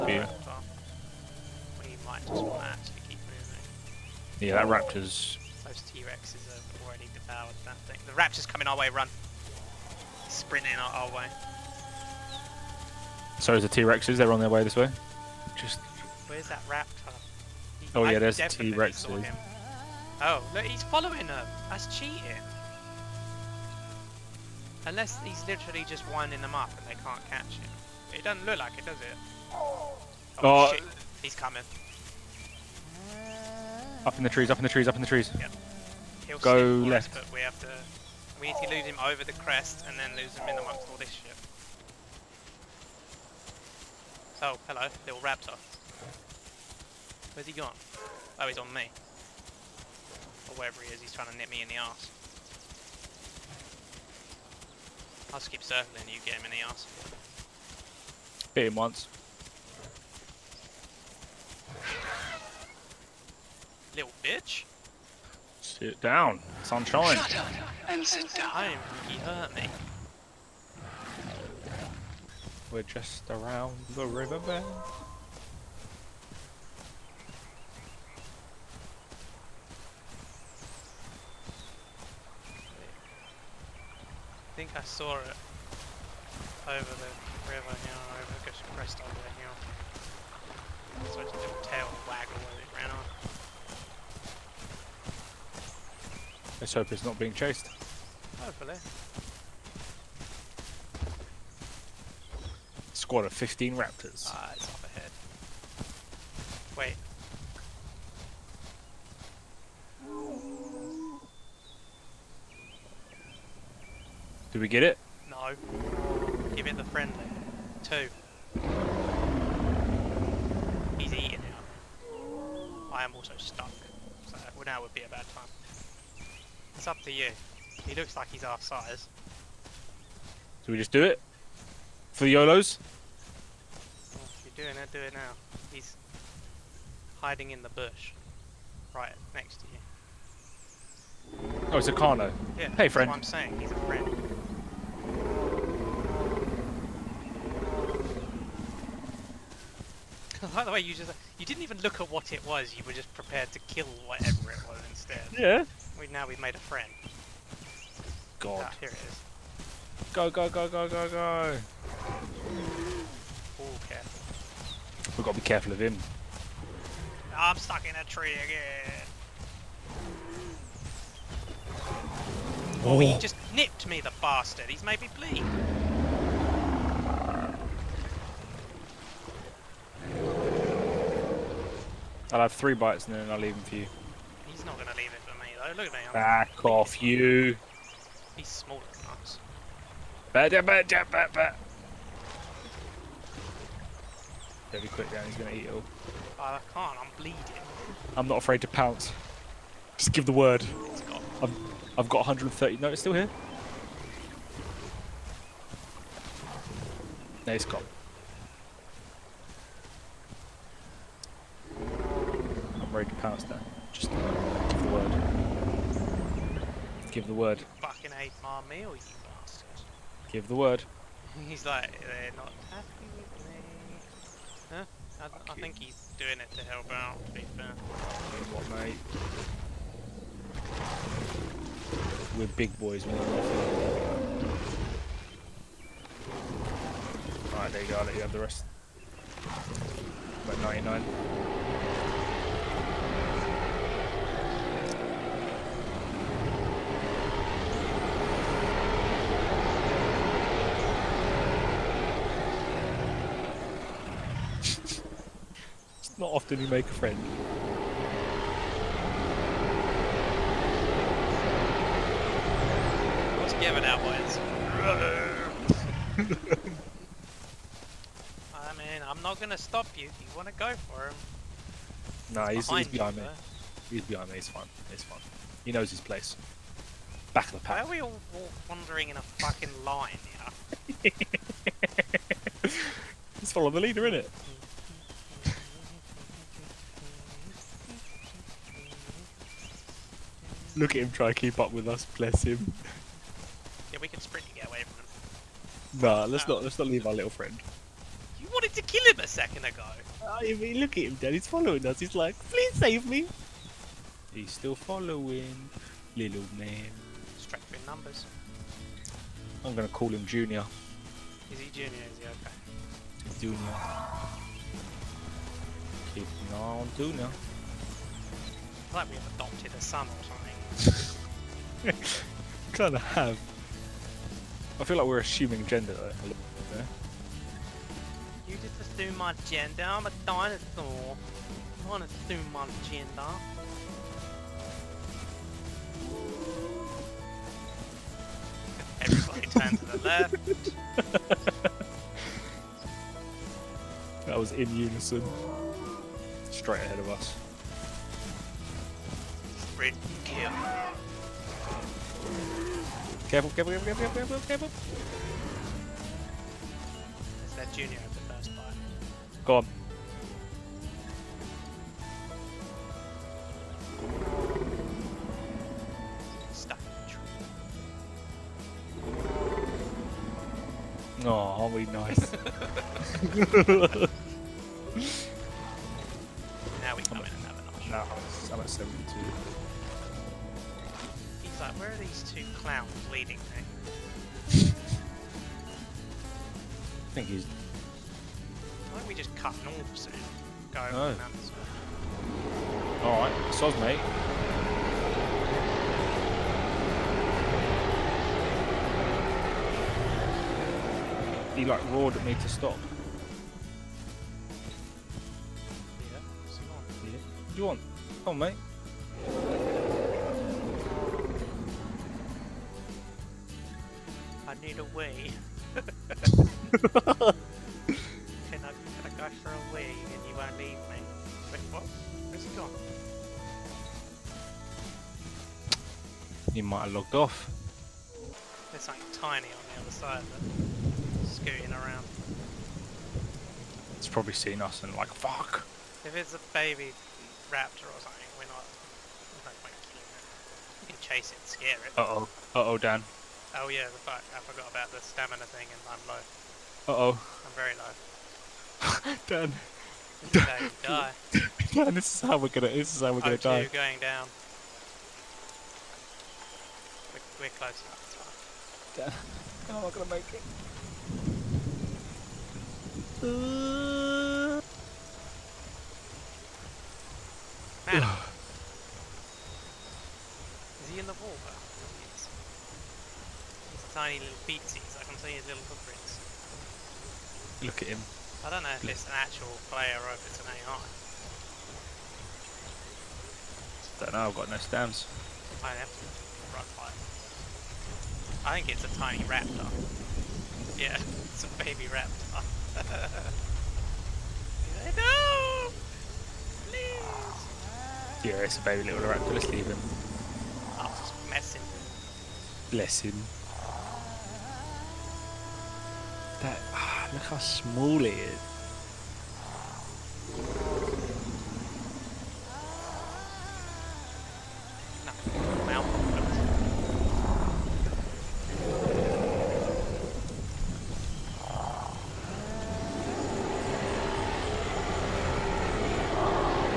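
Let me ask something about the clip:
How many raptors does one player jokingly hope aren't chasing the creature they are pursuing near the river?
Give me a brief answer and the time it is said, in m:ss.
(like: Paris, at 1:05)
15, at 1:43.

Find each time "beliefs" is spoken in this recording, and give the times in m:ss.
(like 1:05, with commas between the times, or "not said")
not said.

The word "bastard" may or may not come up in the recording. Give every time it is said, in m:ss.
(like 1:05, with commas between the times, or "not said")
2:54, 3:39.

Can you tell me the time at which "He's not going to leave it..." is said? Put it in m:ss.
3:04.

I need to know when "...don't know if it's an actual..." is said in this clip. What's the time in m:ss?
7:58.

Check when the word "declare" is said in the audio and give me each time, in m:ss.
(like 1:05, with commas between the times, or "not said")
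not said.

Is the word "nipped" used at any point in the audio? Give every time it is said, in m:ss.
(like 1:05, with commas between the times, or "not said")
2:53.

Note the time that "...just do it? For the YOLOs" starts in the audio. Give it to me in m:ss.
2:10.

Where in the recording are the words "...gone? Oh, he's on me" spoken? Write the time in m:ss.
0:47.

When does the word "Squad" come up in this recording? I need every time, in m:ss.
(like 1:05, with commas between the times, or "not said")
1:42.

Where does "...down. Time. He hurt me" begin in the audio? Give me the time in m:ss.
1:08.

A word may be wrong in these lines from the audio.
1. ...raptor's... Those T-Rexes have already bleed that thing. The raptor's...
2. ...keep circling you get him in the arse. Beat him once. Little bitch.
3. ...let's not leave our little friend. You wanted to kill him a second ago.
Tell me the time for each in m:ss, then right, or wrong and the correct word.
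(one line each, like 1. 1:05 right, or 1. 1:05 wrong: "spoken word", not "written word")
1. 0:04 wrong: "devoured", not "bleed"
2. 0:55 right
3. 4:56 right.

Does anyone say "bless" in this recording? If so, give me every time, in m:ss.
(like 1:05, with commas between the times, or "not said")
4:52, 8:22.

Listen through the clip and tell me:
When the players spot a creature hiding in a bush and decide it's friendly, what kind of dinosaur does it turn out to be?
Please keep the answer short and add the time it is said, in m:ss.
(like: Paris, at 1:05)
Carno, at 2:21.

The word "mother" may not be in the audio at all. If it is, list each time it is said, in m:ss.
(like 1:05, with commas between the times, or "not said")
not said.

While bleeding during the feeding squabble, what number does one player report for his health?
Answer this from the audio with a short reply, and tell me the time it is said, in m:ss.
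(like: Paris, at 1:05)
130, at 3:22.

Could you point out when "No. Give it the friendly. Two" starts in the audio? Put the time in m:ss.
1:55.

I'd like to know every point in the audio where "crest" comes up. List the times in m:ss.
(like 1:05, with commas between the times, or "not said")
0:39, 1:28.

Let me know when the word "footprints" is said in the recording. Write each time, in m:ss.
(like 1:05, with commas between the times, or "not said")
7:55.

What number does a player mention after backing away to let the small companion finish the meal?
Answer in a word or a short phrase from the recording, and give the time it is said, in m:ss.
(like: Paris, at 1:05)
99, at 4:00.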